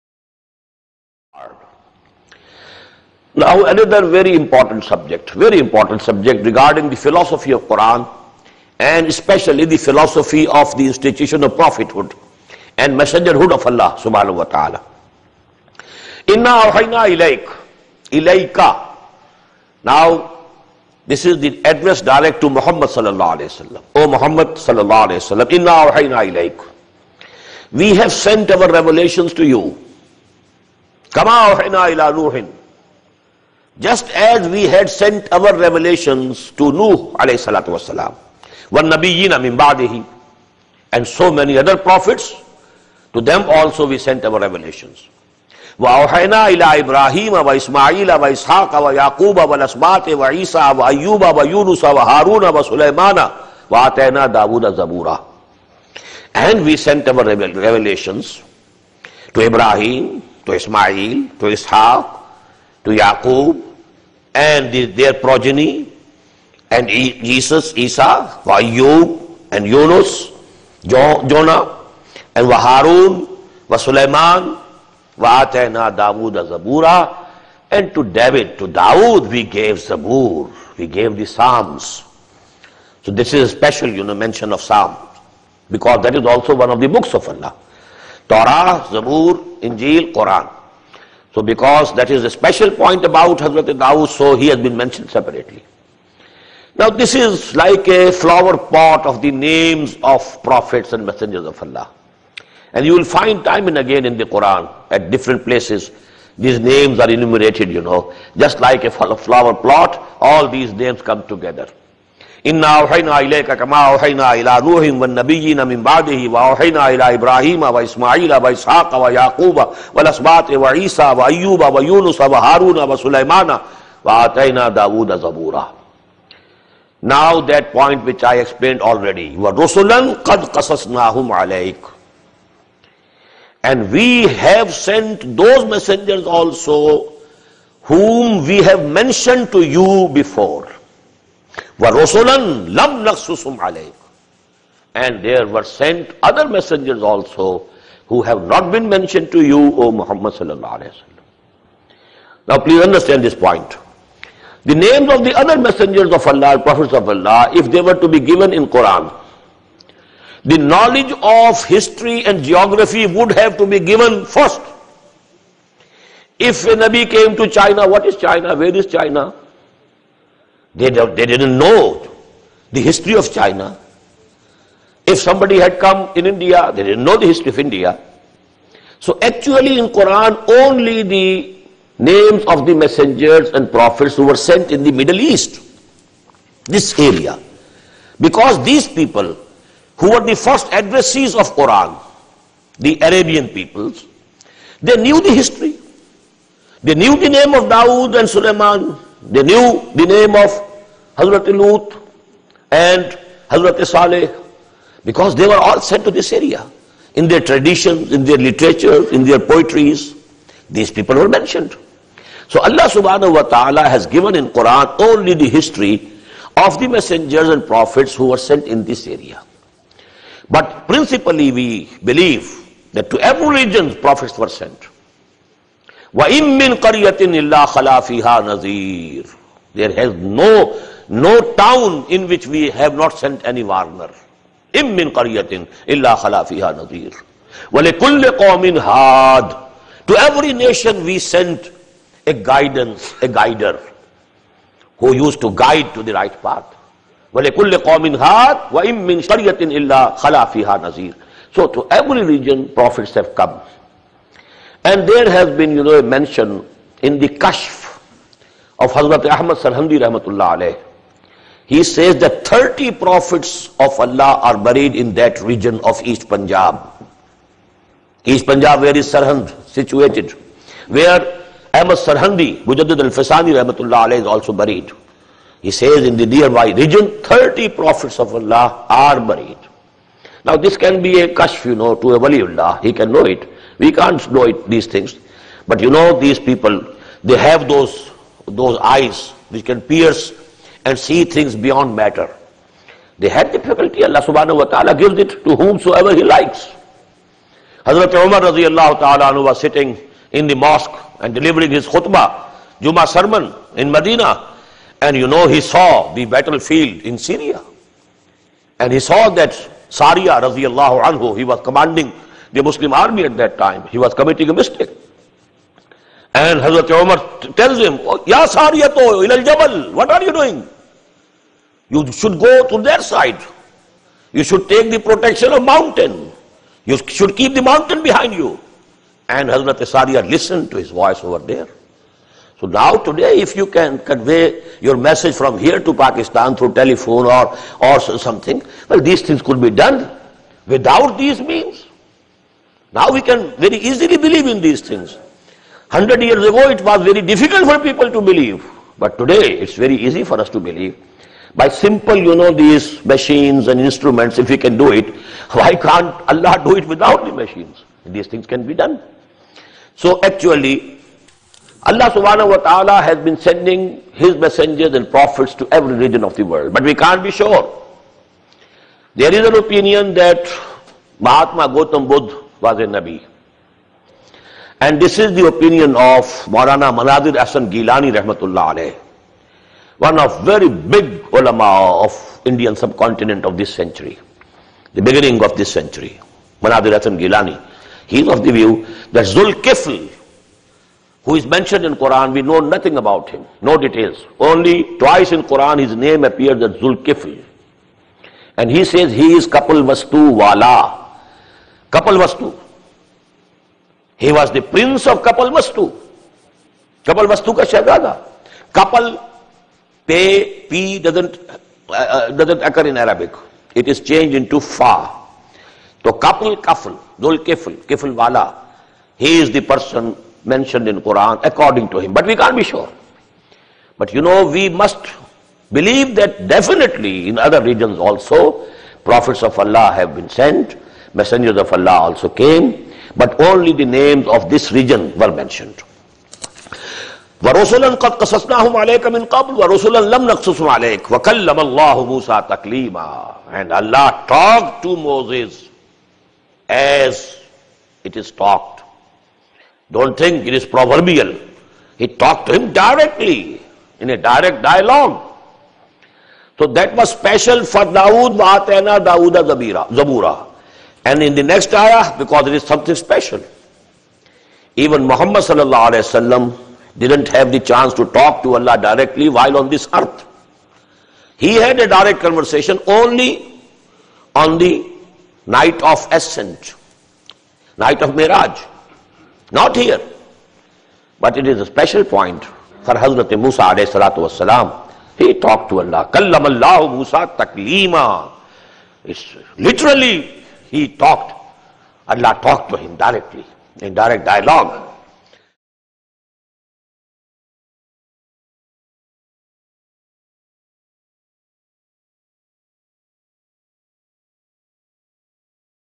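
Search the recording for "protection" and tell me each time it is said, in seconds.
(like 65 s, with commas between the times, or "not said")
324 s.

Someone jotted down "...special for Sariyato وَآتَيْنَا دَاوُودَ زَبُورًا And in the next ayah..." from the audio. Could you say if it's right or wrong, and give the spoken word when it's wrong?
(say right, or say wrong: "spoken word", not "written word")
wrong: "Dawood", not "Sariyato".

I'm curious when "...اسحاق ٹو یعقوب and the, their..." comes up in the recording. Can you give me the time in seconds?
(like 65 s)
61 s.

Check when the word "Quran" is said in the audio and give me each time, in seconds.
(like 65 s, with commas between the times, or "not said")
90 s, 104 s, 158 s, 179 s, 191 s, 214 s, 421 s.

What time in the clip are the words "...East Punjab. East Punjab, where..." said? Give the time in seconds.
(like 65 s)
266 s.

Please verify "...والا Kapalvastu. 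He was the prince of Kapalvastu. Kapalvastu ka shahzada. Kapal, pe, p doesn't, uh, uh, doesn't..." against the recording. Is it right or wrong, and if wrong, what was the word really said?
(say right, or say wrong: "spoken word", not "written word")
right.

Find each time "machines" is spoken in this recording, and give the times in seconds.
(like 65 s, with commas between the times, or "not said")
353 s, 357 s.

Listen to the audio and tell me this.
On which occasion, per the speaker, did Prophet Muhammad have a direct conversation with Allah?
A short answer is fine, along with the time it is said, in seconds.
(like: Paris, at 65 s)
Night of Miraj, at 477 s.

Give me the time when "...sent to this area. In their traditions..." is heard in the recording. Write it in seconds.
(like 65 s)
205 s.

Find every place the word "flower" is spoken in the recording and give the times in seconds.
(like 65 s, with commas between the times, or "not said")
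98 s, 108 s.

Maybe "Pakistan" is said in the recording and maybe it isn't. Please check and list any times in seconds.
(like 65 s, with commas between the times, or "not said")
335 s.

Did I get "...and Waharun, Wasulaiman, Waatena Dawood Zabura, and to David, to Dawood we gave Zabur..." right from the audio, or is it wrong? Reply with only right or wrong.
right.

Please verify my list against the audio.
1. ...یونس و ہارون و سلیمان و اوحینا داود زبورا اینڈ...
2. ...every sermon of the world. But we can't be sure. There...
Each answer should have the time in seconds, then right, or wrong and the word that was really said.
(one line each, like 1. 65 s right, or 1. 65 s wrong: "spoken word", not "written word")
1. 51 s wrong: "آتینا", not "اوحینا"
2. 365 s wrong: "region", not "sermon".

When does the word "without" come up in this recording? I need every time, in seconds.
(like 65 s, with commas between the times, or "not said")
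340 s, 356 s.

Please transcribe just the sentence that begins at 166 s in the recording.
If a Nabi came to China, what is China?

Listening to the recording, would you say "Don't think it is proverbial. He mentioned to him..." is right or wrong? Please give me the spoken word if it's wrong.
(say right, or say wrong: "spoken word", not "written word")
wrong: "talked", not "mentioned".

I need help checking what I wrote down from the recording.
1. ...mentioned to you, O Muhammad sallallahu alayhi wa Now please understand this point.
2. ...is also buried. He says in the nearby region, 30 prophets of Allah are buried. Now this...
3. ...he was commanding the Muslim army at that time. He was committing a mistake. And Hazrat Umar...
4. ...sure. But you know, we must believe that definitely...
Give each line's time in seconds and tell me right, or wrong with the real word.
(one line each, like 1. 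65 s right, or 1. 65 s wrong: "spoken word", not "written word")
1. 148 s right
2. 274 s right
3. 311 s right
4. 422 s right.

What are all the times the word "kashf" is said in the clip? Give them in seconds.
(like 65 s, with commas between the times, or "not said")
257 s, 281 s.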